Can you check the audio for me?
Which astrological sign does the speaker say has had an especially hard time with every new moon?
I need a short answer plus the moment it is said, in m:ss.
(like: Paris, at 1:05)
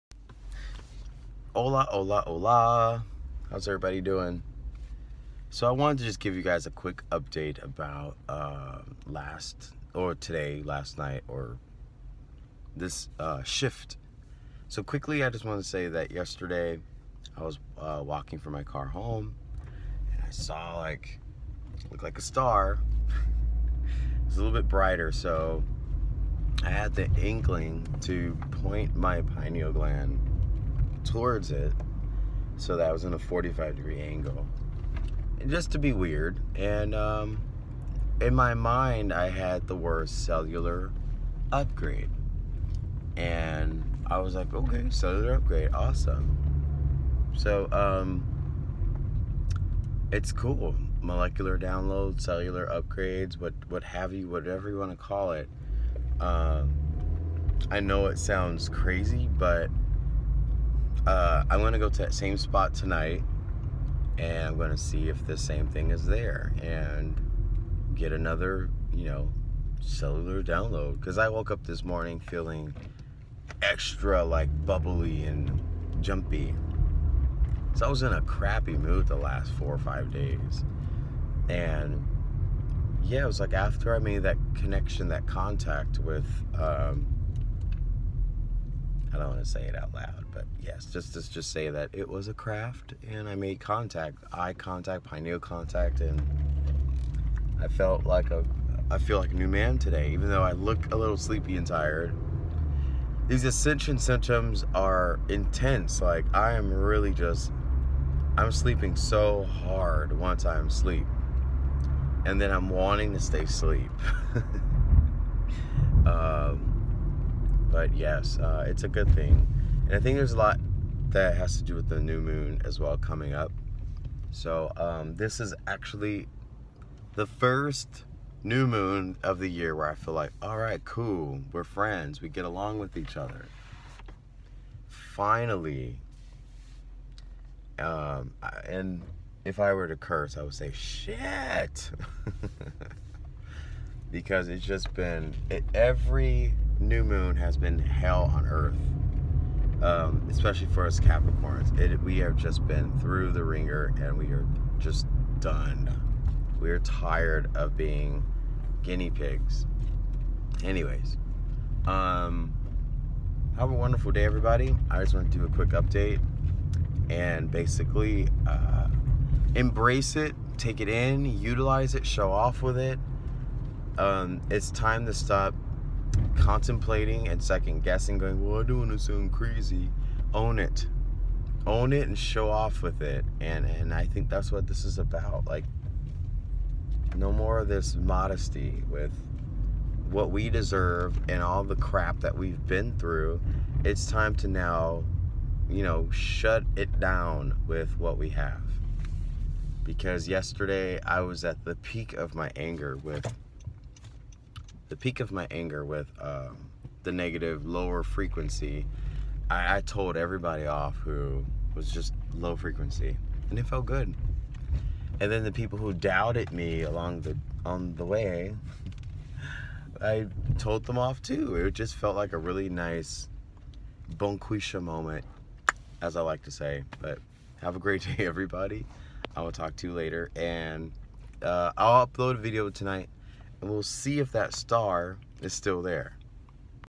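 Capricorns, at 2:30.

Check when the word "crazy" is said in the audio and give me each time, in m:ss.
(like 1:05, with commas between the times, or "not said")
0:58, 2:59.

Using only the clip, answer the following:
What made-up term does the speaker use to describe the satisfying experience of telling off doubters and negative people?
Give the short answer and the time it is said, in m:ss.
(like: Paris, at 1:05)
bonquisha moment, at 3:44.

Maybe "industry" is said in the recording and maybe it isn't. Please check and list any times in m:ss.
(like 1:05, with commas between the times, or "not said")
not said.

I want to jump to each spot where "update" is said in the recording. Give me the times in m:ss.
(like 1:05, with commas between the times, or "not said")
0:07, 2:45.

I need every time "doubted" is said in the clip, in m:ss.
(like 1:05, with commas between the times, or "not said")
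3:35.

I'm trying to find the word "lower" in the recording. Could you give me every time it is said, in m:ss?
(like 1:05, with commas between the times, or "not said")
3:27.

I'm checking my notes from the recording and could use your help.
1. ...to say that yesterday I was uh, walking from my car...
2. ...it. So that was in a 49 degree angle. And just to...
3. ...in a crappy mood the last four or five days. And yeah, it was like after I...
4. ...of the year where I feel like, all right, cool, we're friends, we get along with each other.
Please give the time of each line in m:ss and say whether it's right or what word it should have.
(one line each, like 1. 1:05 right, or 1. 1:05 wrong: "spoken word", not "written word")
1. 0:15 right
2. 0:31 wrong: "45", not "49"
3. 1:18 right
4. 2:09 right.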